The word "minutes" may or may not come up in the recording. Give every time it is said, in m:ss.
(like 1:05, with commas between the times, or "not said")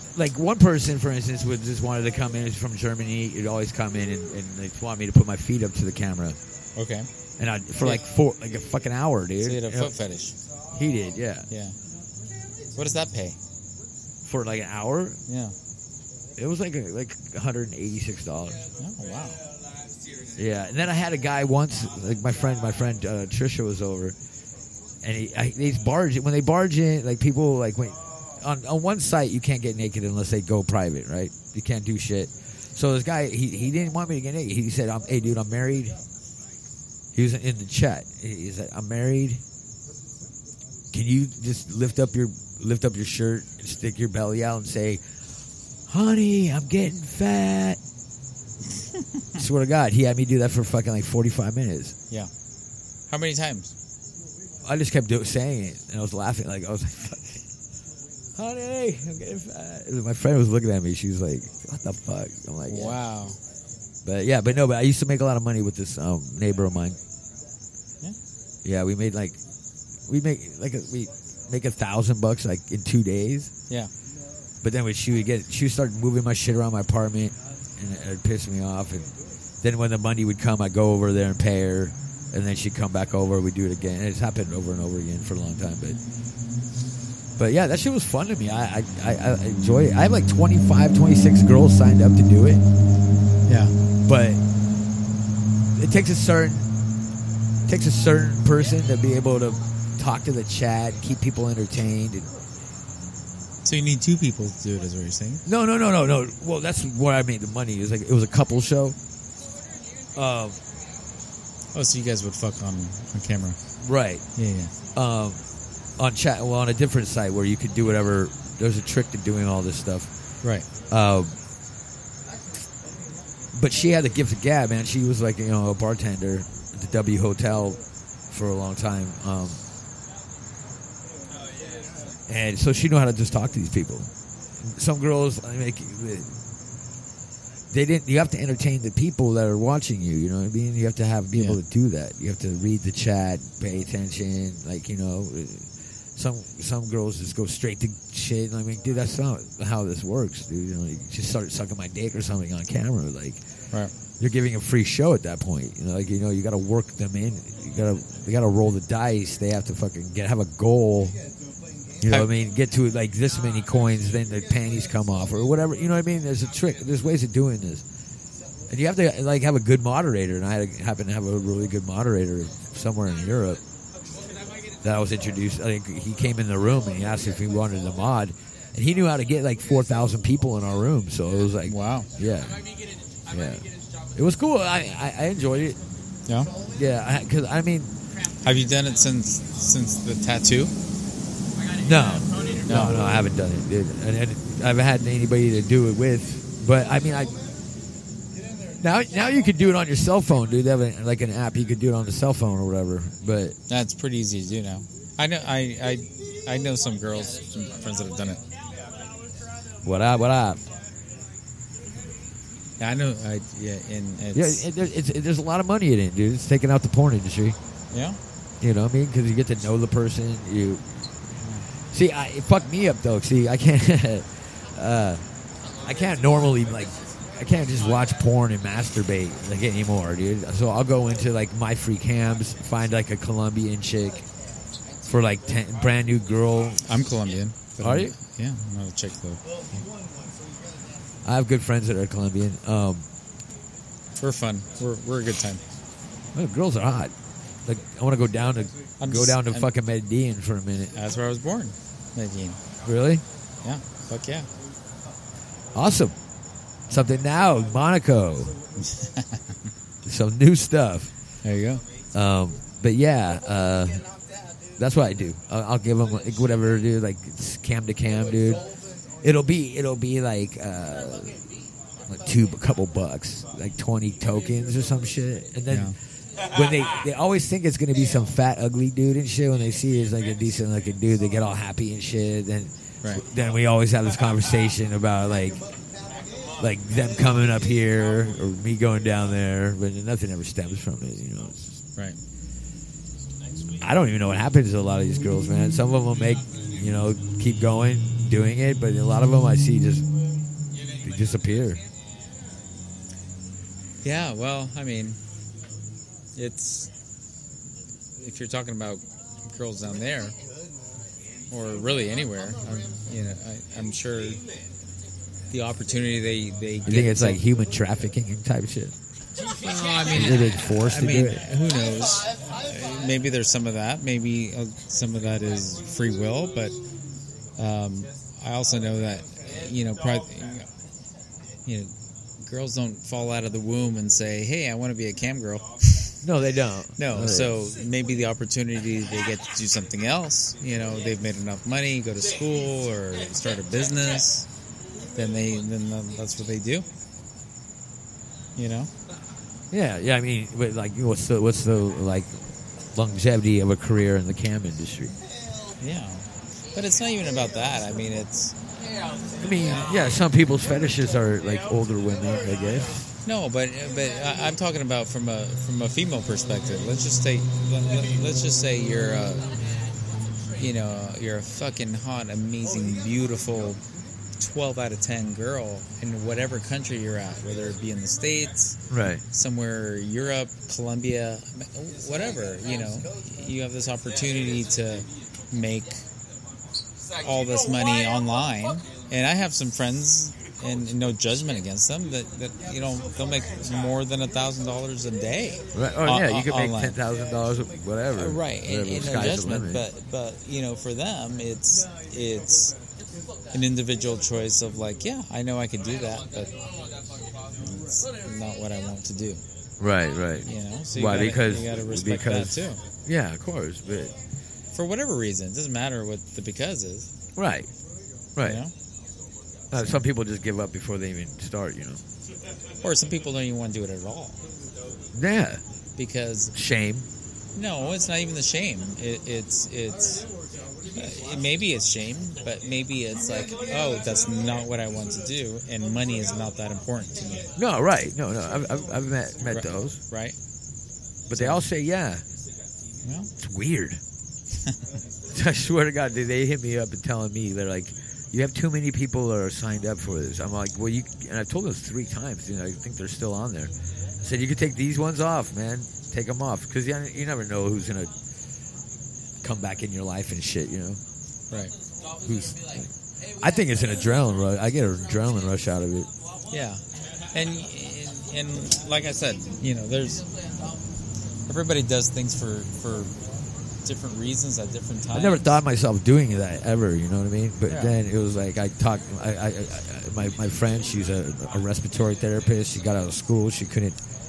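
0:51, 4:10.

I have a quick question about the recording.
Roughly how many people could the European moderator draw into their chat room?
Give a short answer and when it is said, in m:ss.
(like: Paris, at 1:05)
4000, at 2:59.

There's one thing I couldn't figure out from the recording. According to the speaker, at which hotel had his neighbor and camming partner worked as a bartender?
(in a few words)
W Hotel.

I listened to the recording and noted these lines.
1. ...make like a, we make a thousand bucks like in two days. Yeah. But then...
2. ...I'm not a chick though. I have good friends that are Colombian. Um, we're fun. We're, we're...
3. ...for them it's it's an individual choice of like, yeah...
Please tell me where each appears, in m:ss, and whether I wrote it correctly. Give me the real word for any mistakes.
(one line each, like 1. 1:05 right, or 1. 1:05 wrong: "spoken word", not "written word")
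1. 1:10 right
2. 3:58 right
3. 6:40 right.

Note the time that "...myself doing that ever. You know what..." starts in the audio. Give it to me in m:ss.
7:55.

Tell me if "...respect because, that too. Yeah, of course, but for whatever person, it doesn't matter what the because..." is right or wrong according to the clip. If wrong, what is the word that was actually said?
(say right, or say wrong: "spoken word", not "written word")
wrong: "reason", not "person".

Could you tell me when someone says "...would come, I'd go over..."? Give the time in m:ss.
1:20.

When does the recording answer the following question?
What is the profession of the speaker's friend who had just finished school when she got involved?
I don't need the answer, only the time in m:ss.
8:01.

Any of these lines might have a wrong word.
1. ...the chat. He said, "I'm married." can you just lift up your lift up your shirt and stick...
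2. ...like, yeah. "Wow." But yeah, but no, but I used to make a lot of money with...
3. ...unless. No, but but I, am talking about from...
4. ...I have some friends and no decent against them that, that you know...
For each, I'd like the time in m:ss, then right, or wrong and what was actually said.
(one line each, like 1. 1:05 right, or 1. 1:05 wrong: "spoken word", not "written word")
1. 0:37 right
2. 1:02 right
3. 6:02 wrong: "guess", not "unless"
4. 6:29 wrong: "judgment", not "decent".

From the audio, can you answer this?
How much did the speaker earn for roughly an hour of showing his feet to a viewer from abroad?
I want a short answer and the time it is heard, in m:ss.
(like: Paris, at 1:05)
$186, at 0:17.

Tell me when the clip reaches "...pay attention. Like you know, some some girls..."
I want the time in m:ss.
2:23.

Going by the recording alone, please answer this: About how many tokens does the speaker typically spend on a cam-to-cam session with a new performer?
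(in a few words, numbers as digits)
20.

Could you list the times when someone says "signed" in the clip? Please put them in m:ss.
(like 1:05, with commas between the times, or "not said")
1:31, 7:29.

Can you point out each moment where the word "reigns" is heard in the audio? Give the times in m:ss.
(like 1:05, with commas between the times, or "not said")
not said.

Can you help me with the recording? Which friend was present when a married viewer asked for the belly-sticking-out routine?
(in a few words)
Trisha.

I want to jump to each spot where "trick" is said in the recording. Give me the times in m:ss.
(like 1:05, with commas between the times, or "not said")
1:58, 2:46.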